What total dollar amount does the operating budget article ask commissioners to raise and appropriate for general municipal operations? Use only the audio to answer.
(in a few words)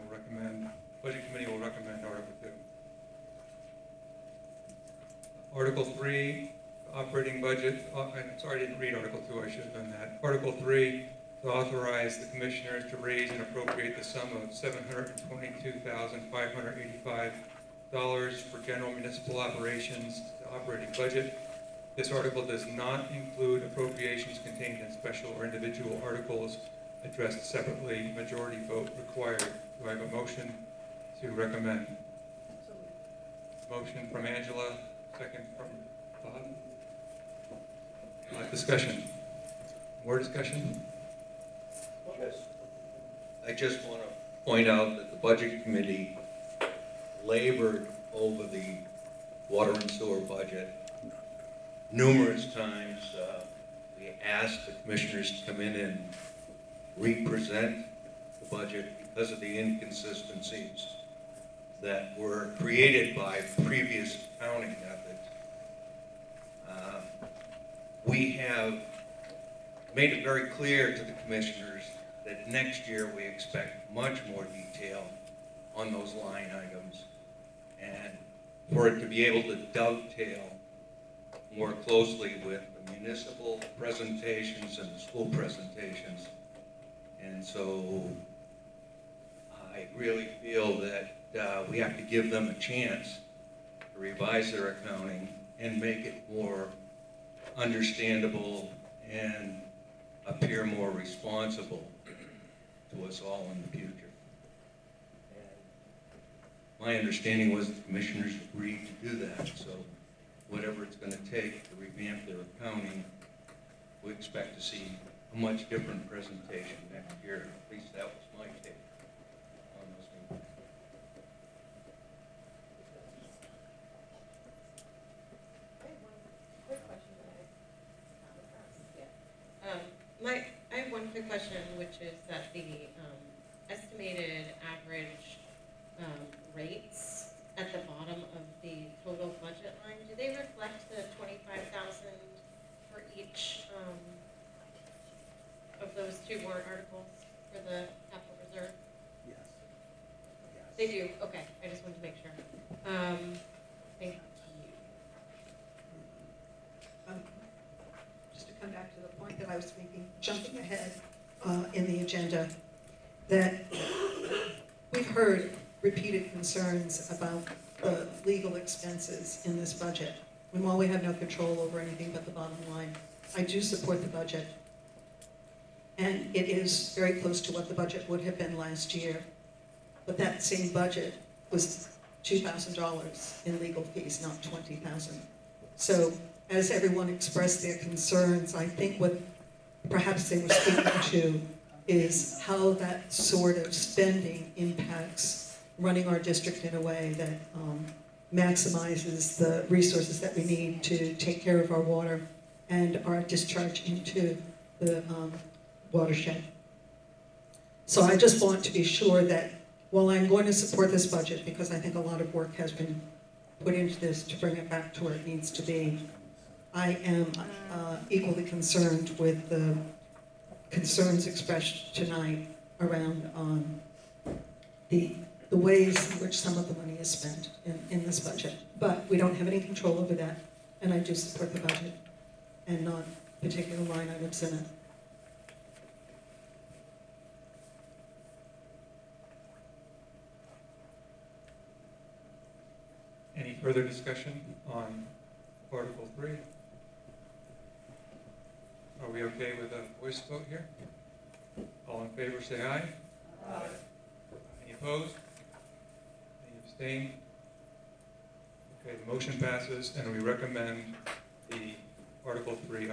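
$722,585.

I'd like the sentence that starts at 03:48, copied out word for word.
But we don't have any control over that, and I do support the budget and not particular line items in it.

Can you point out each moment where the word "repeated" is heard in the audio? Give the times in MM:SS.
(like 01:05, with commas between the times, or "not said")
02:45.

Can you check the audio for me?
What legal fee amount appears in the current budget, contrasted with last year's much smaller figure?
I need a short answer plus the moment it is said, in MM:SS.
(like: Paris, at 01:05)
20,000, at 03:04.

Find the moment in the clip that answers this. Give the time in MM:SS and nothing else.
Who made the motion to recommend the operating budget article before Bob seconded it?
00:34.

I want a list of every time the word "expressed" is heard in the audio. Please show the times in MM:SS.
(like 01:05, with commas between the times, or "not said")
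03:07, 03:41.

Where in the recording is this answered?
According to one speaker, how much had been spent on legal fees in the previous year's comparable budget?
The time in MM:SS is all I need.
03:02.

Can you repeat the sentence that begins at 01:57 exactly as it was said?
At least that was my take.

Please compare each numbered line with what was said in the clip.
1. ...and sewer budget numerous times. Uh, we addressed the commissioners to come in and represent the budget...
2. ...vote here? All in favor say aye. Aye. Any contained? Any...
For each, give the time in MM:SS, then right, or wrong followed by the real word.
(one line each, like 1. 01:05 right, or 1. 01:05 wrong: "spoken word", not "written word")
1. 00:49 wrong: "asked", not "addressed"
2. 04:10 wrong: "opposed", not "contained".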